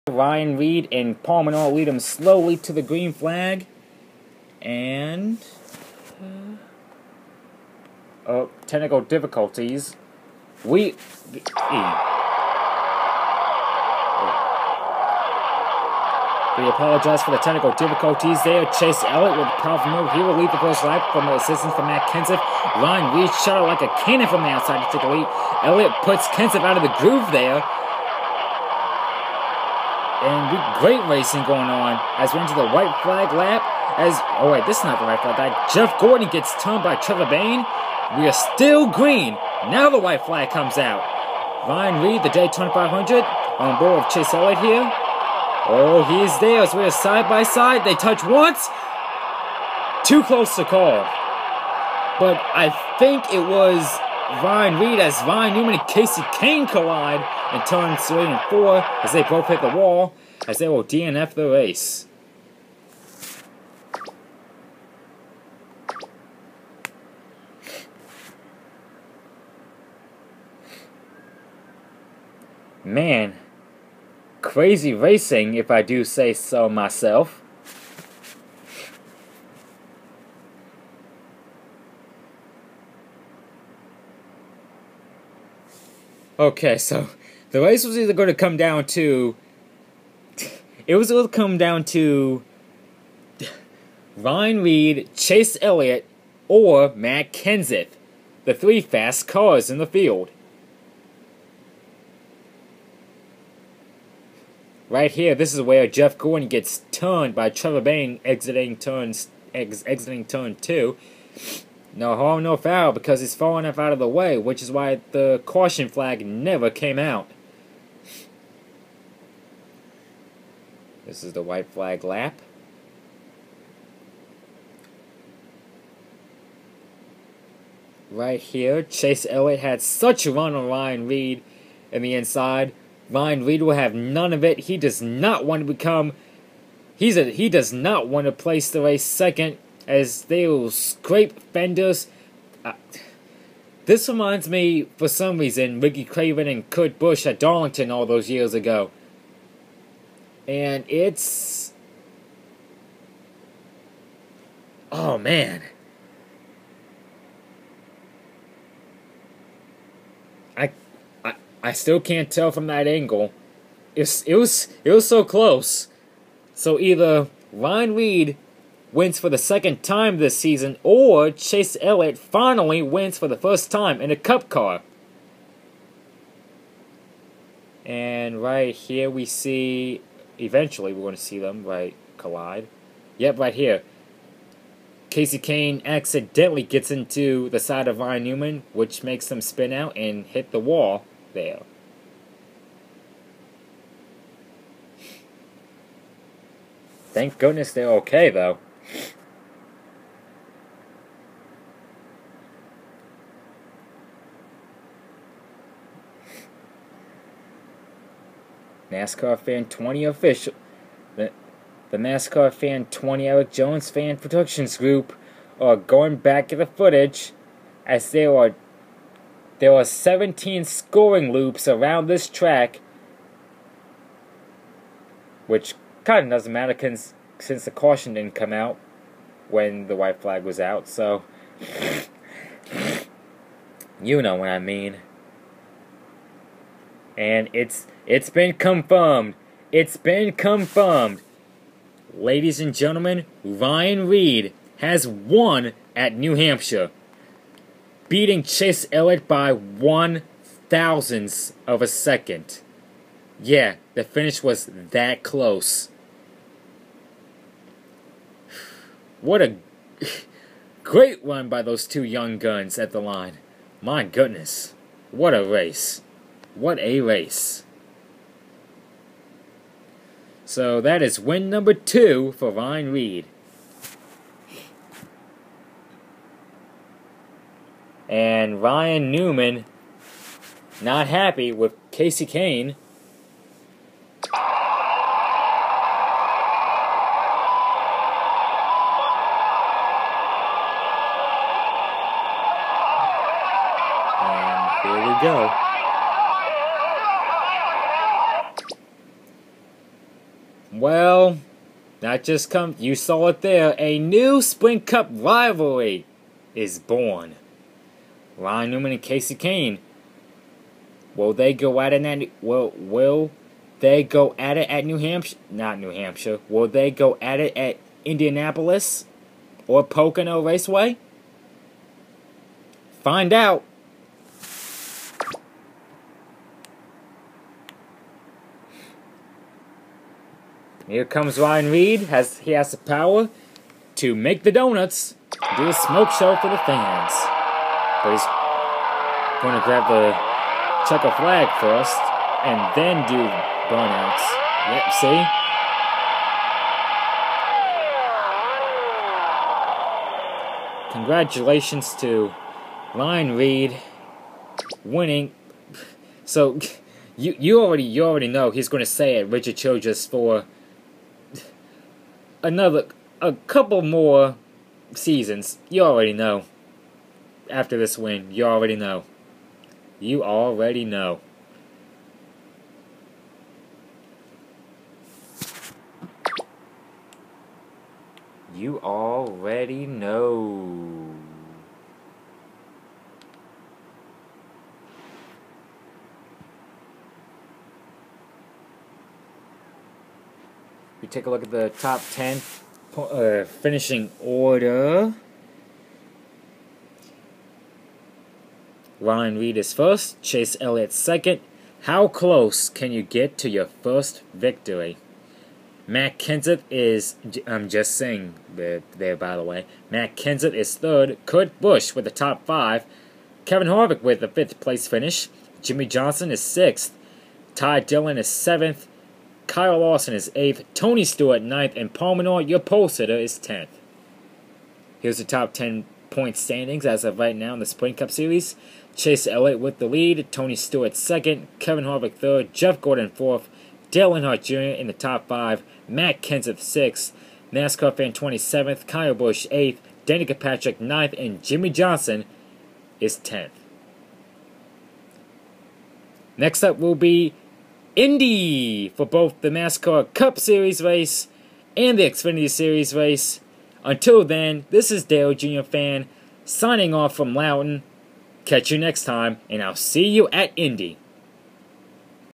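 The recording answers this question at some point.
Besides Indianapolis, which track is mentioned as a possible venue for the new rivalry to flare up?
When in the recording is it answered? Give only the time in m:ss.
5:19.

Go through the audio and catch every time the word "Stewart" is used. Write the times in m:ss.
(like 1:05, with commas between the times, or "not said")
7:01, 7:10.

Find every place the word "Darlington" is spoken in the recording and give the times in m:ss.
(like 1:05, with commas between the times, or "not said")
2:27.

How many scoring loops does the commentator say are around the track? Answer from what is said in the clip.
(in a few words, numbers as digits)
17.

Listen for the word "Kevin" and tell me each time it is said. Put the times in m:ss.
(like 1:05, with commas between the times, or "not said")
6:53, 7:11.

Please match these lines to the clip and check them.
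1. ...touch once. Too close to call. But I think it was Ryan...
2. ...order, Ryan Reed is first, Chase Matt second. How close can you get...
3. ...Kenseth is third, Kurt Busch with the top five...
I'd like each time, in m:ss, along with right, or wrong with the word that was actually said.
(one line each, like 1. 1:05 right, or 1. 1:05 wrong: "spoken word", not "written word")
1. 0:47 right
2. 6:34 wrong: "Elliott", not "Matt"
3. 6:50 right.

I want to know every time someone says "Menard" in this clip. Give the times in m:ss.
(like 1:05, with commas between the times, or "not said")
0:01, 7:02.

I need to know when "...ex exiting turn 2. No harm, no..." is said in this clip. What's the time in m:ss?
1:49.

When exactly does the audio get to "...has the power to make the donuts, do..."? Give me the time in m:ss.
5:32.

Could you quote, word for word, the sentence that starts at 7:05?
Here's the top 10 point standings as of right now in the Sprint Cup Series.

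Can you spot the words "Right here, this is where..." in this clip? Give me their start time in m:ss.
1:44.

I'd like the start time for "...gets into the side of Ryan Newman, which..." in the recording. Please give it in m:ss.
3:06.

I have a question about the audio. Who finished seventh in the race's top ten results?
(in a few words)
Ty Dillon.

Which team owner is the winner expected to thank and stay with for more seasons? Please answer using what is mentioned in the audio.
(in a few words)
Richard Childress.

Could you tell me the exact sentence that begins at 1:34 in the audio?
Ryan Reed, Chase Elliott, or Matt Kenseth, the three fast cars in the field.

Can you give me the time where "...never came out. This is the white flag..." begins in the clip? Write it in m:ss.
1:56.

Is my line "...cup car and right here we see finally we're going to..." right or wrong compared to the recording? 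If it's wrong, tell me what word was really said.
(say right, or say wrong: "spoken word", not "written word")
wrong: "eventually", not "finally".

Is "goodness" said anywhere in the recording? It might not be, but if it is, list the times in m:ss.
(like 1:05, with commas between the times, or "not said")
3:17, 4:24.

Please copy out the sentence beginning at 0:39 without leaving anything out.
Now the white flag comes out.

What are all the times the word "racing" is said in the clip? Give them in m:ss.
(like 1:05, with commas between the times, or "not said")
0:31, 1:14.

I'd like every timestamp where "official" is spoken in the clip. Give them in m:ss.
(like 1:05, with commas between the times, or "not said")
3:30.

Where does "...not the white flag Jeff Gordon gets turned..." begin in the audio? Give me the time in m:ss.
0:34.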